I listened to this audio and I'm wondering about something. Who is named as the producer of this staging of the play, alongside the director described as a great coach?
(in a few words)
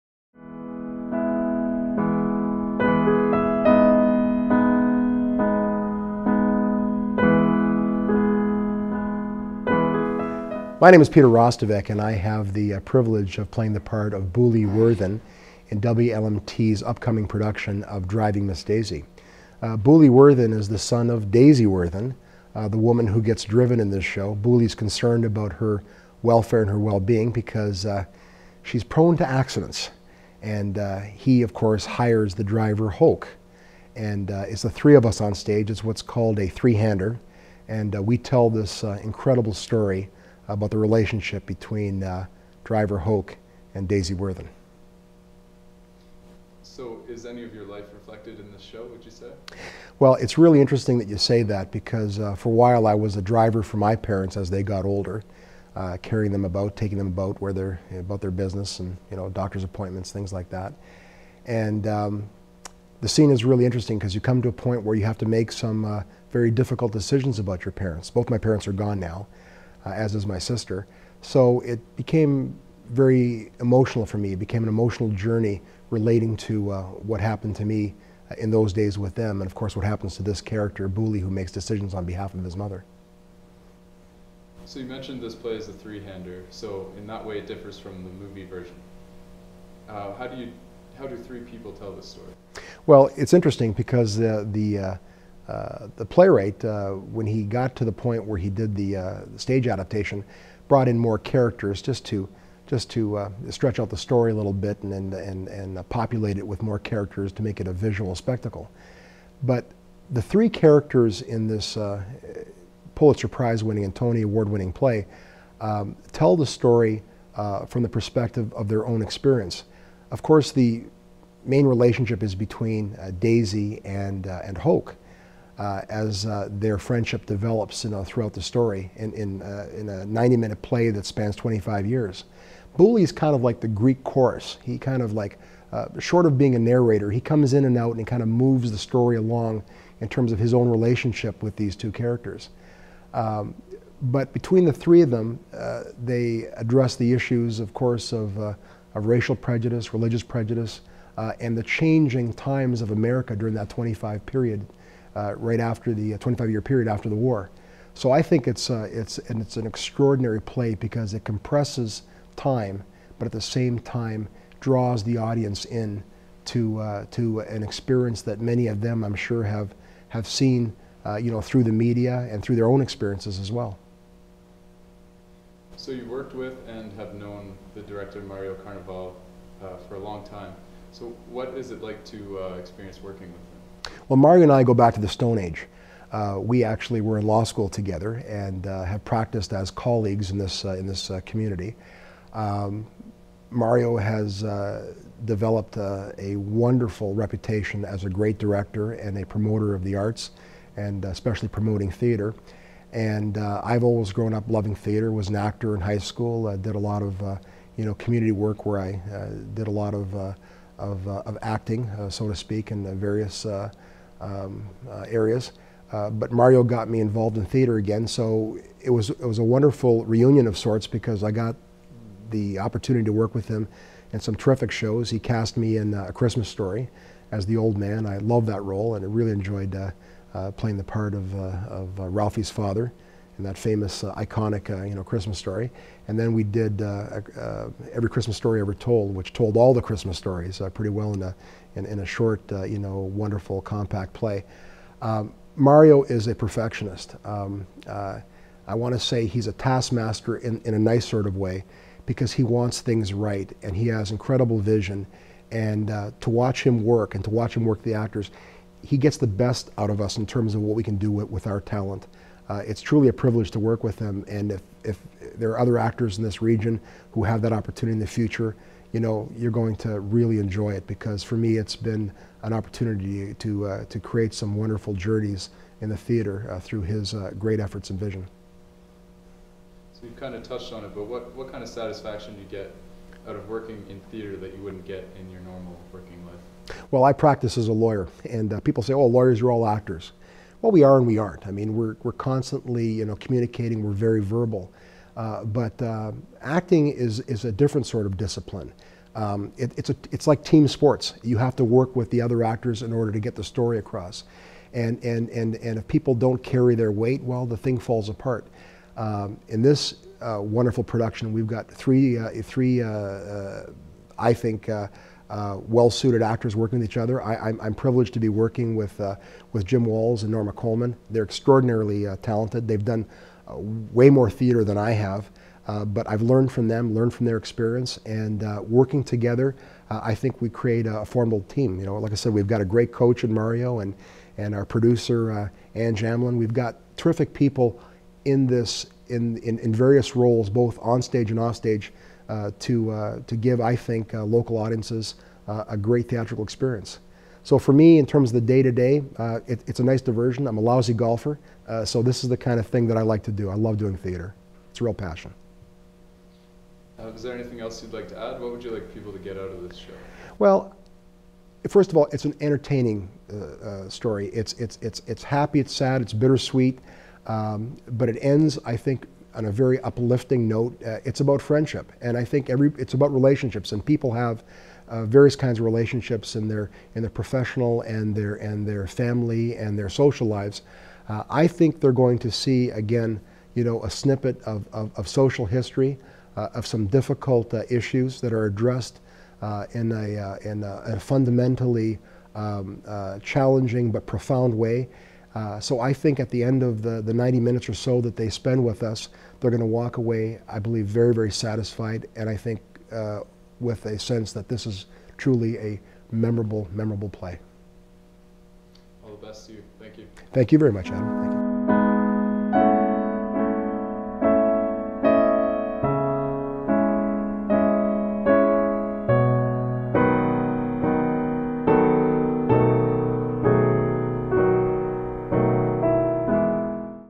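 Ann Jamlin.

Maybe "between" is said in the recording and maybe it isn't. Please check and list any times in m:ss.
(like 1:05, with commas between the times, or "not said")
0:41, 2:02, 2:24.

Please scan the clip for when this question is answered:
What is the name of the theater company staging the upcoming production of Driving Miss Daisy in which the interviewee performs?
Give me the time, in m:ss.
0:15.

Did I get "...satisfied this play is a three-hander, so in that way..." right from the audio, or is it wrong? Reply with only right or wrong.
wrong.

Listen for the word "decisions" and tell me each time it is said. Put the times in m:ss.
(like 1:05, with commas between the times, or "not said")
1:06, 1:21.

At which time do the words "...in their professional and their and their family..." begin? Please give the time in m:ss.
6:16.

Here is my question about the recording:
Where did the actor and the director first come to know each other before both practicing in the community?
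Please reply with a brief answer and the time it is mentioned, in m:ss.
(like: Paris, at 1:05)
law school, at 3:07.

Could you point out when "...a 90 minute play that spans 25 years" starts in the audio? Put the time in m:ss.
2:09.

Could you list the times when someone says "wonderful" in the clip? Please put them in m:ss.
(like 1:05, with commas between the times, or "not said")
3:16, 3:39, 4:02, 4:34, 5:10.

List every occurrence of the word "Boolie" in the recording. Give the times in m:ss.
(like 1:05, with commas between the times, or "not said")
0:14, 0:19, 0:24, 1:20.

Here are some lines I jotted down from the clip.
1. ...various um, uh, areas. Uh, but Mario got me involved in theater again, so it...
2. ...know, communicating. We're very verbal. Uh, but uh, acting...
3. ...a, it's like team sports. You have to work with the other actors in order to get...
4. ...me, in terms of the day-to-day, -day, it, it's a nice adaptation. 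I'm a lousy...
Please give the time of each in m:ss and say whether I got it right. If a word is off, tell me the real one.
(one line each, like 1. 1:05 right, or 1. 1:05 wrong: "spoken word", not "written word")
1. 3:32 right
2. 4:53 right
3. 4:59 right
4. 5:47 wrong: "diversion", not "adaptation".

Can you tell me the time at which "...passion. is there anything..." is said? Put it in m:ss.
5:54.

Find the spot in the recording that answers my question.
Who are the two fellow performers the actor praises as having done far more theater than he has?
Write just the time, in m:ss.
5:19.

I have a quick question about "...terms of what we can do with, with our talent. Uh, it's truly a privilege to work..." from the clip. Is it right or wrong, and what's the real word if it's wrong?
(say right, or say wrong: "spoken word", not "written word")
right.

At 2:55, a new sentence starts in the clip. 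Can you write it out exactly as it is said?
So you worked with and have known the director Mario Carnaval uh, for a long time.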